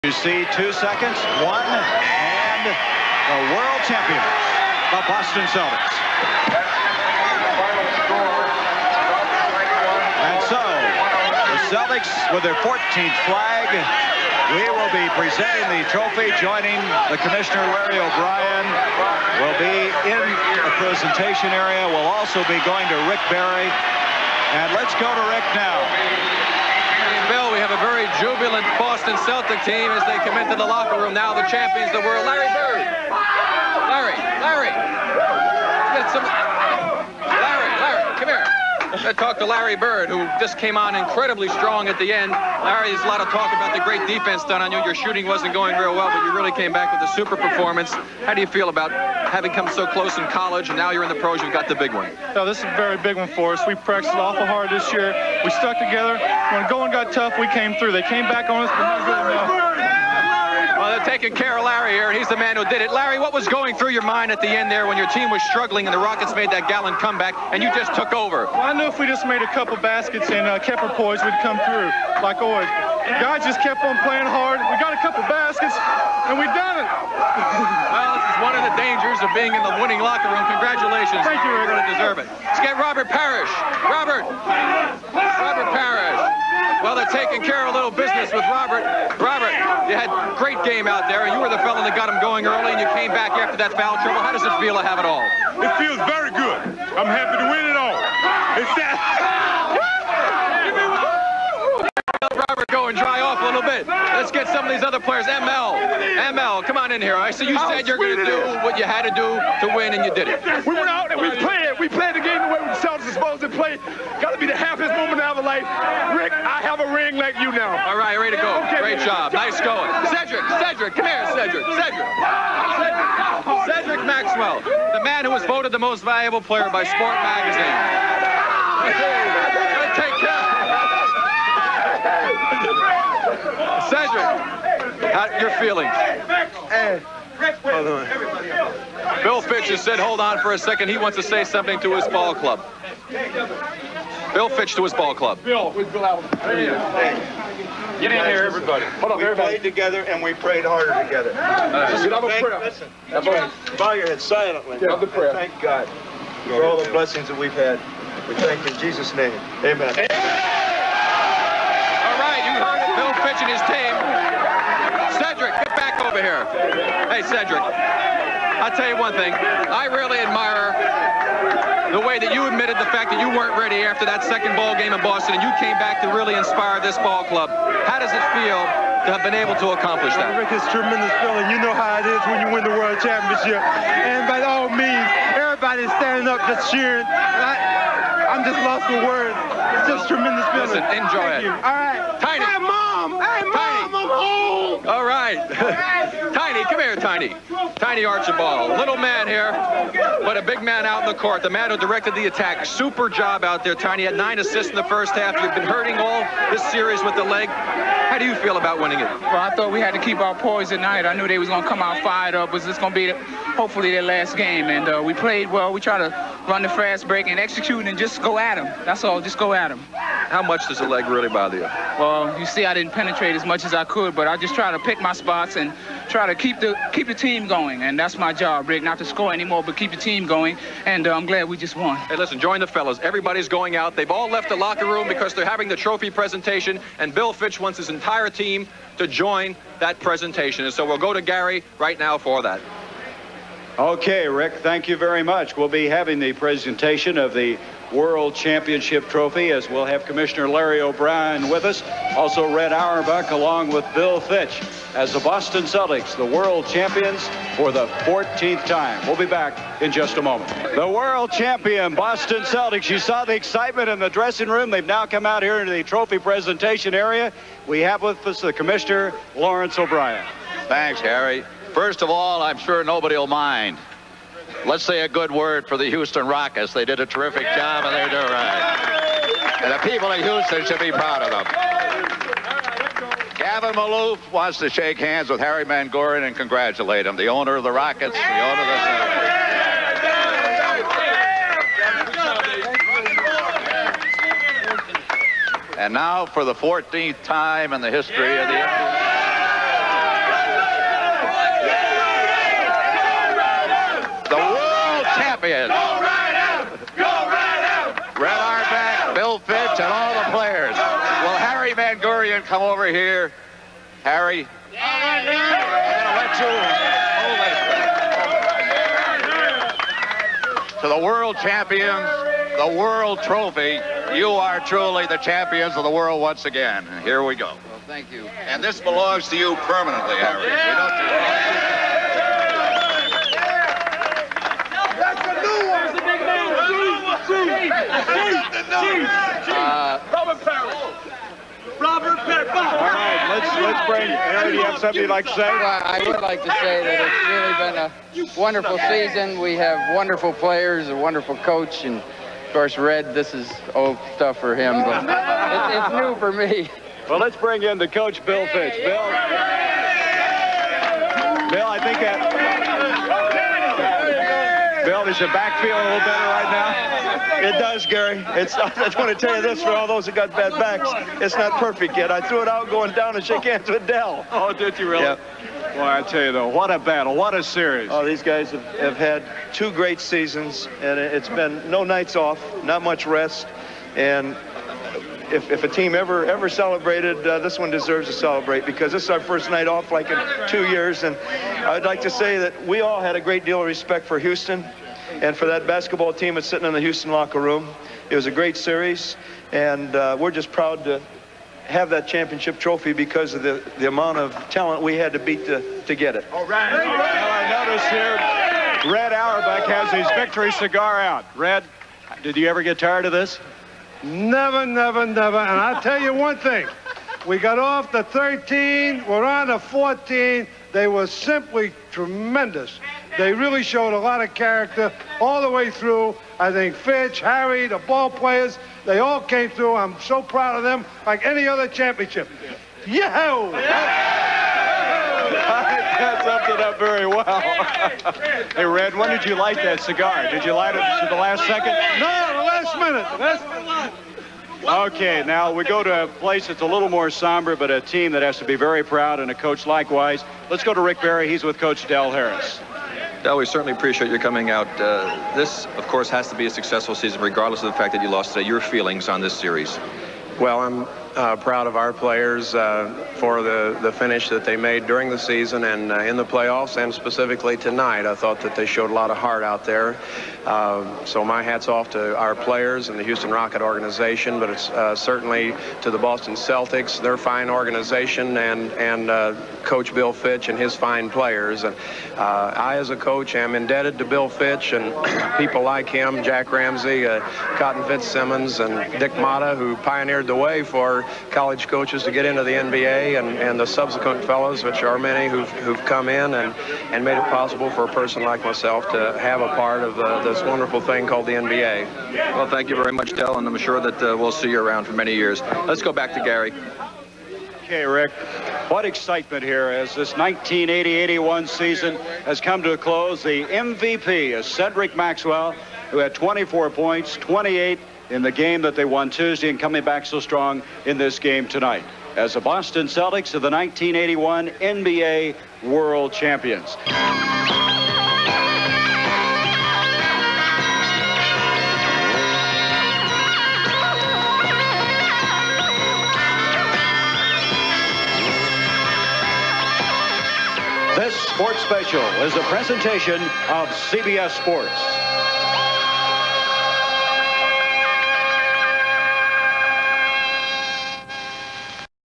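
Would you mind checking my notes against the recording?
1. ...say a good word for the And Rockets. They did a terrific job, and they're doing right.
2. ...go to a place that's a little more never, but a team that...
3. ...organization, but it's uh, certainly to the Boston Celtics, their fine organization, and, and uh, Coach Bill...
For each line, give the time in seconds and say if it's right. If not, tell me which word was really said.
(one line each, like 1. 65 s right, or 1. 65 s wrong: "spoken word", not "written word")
1. 274 s wrong: "Houston", not "And"
2. 445 s wrong: "somber", not "never"
3. 473 s right.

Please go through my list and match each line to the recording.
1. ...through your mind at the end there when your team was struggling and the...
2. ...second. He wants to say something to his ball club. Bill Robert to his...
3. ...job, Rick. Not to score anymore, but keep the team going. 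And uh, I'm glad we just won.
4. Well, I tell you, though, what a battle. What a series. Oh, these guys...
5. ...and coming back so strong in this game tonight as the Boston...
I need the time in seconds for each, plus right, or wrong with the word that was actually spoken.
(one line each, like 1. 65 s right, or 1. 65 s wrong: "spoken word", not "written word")
1. 63 s right
2. 140 s wrong: "Fitch", not "Robert"
3. 228 s right
4. 375 s right
5. 519 s right.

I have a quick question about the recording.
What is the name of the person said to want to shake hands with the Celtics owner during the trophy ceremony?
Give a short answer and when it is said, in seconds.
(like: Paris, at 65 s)
Gavin Maloof, at 283 s.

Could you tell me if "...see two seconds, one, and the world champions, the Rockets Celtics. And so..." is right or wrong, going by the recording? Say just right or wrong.
wrong.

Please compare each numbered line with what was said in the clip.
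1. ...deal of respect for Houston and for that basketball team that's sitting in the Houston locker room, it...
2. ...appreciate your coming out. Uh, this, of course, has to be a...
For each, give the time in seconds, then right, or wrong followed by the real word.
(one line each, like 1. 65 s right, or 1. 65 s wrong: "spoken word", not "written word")
1. 393 s right
2. 453 s right.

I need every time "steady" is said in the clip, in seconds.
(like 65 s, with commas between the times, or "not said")
not said.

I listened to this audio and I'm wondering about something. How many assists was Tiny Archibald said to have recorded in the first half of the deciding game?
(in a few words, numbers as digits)
9.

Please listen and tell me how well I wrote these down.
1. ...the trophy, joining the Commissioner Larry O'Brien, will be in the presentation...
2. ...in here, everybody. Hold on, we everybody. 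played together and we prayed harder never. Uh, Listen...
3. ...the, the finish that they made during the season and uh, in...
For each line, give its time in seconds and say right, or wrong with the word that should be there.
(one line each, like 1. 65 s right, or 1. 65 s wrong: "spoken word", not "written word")
1. 15 s right
2. 148 s wrong: "together", not "never"
3. 463 s right.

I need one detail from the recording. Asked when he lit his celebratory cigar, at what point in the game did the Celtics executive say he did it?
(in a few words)
The last minute.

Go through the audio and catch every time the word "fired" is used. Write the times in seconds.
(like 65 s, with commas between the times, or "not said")
212 s.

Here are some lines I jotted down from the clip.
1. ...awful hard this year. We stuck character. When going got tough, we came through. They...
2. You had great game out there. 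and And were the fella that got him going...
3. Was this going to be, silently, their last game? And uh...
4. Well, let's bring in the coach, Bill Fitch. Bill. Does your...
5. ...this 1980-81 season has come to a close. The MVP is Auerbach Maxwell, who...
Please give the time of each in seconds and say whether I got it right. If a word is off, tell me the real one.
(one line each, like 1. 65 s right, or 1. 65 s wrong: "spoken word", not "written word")
1. 54 s wrong: "together", not "character"
2. 89 s wrong: "You", not "And"
3. 212 s wrong: "hopefully", not "silently"
4. 357 s right
5. 509 s wrong: "Cedric", not "Auerbach".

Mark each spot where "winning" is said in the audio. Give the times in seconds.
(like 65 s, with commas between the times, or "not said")
79 s, 208 s.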